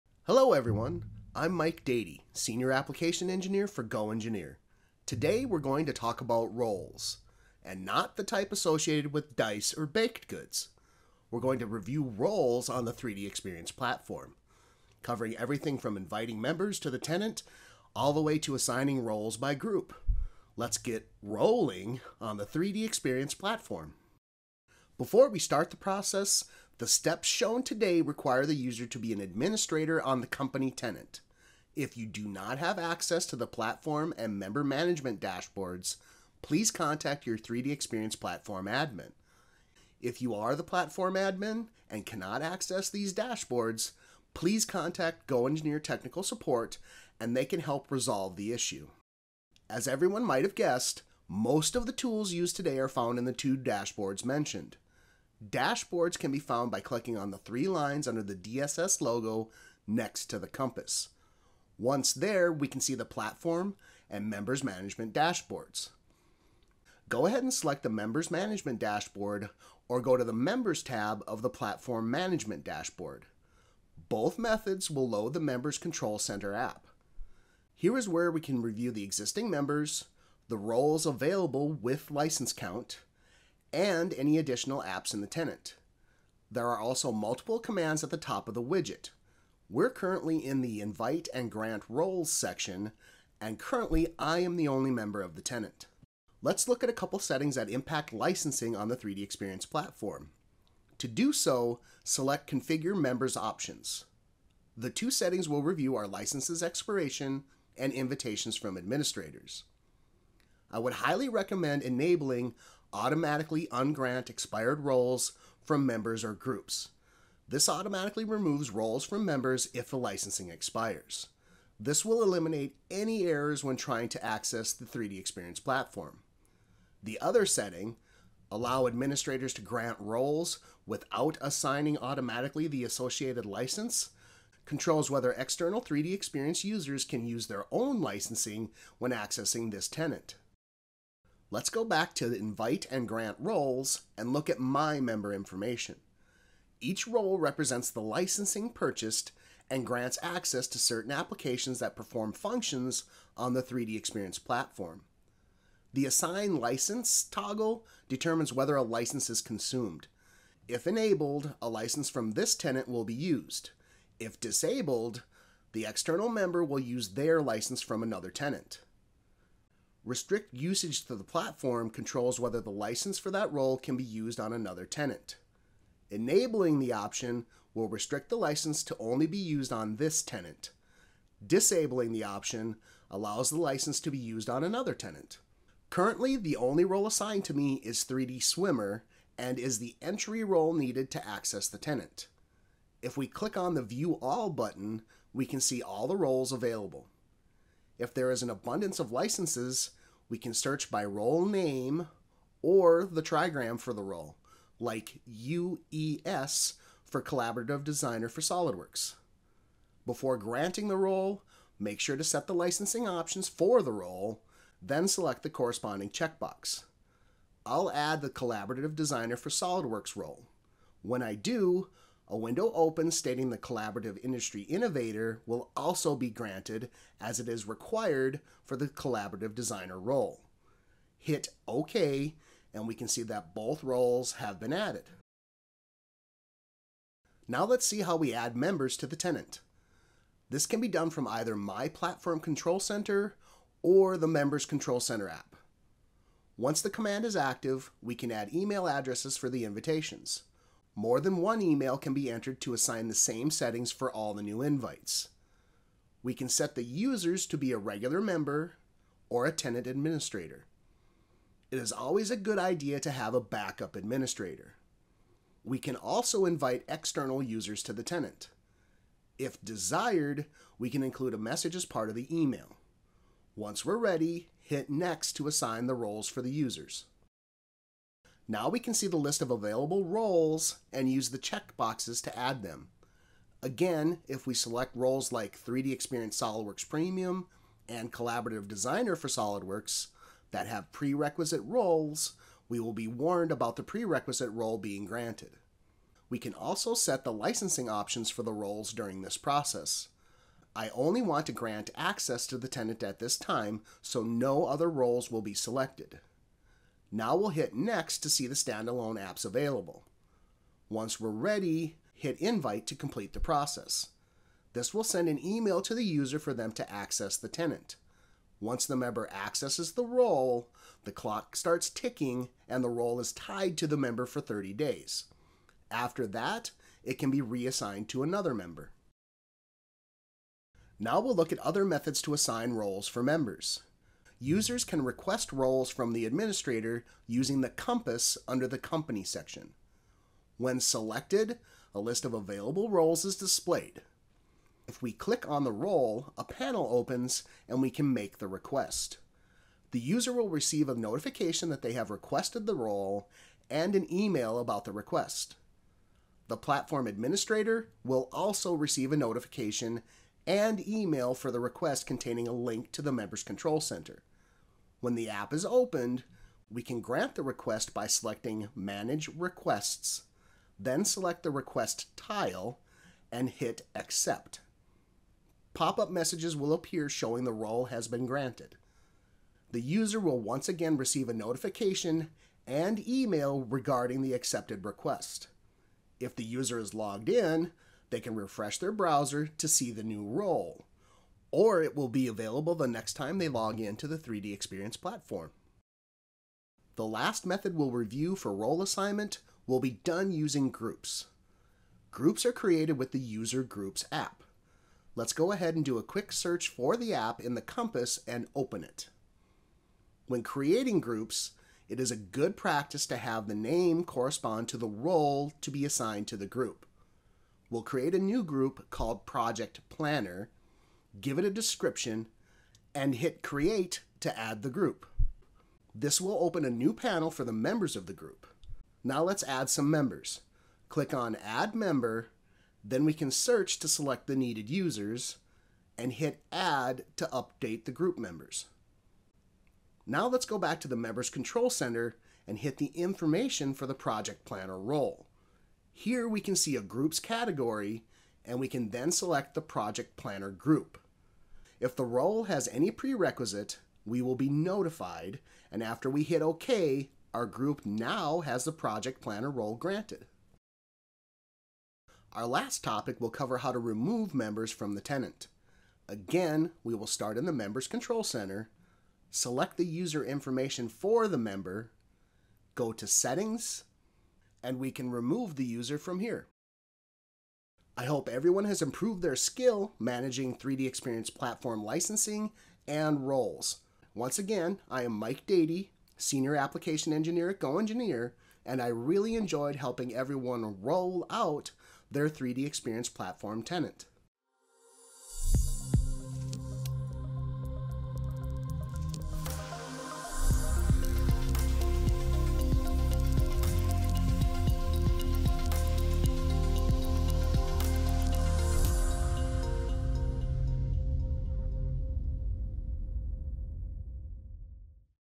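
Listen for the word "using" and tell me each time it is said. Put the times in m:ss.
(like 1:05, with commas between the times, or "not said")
5:37, 6:40.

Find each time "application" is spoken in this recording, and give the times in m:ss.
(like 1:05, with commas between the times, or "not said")
0:02, 2:31, 8:06.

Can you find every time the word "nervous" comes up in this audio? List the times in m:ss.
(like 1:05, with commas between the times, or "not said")
not said.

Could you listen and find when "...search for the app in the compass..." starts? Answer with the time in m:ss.
6:46.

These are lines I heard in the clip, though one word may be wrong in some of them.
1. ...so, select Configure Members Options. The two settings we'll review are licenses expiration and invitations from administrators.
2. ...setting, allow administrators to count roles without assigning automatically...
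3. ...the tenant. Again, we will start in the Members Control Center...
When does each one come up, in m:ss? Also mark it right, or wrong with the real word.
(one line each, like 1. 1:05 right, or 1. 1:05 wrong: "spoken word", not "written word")
1. 1:41 right
2. 2:07 wrong: "grant", not "count"
3. 7:44 right.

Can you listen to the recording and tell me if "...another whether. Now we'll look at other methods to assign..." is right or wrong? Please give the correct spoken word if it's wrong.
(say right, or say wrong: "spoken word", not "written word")
wrong: "member", not "whether".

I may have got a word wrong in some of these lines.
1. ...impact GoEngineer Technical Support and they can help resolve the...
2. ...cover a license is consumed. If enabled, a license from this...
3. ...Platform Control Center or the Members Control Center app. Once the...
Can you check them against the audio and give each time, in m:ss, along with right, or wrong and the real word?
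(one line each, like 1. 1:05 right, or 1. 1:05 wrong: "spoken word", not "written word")
1. 0:44 wrong: "contact", not "impact"
2. 2:38 wrong: "whether", not "cover"
3. 4:01 right.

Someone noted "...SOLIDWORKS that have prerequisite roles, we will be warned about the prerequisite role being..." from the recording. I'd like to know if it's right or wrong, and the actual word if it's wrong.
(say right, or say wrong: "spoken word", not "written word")
right.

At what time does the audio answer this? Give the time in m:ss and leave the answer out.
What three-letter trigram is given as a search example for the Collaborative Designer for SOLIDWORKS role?
3:25.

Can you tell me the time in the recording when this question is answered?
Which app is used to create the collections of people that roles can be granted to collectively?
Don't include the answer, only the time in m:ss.
6:43.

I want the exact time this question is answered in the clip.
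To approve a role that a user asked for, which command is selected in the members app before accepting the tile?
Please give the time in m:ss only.
6:08.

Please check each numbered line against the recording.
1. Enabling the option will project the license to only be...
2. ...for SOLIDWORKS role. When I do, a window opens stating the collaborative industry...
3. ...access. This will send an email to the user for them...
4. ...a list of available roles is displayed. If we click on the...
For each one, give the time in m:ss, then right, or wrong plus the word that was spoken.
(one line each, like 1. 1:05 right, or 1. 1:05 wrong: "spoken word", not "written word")
1. 2:56 wrong: "restrict", not "project"
2. 3:39 right
3. 5:13 wrong: "process", not "access"
4. 5:41 right.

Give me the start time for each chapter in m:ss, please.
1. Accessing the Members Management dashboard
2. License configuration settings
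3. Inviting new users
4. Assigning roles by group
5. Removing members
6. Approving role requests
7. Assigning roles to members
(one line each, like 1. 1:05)
1. 0:24
2. 2:26
3. 3:57
4. 6:36
5. 7:42
6. 5:34
7. 3:12.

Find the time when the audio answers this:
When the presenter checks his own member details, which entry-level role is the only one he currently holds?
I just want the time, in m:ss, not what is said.
3:08.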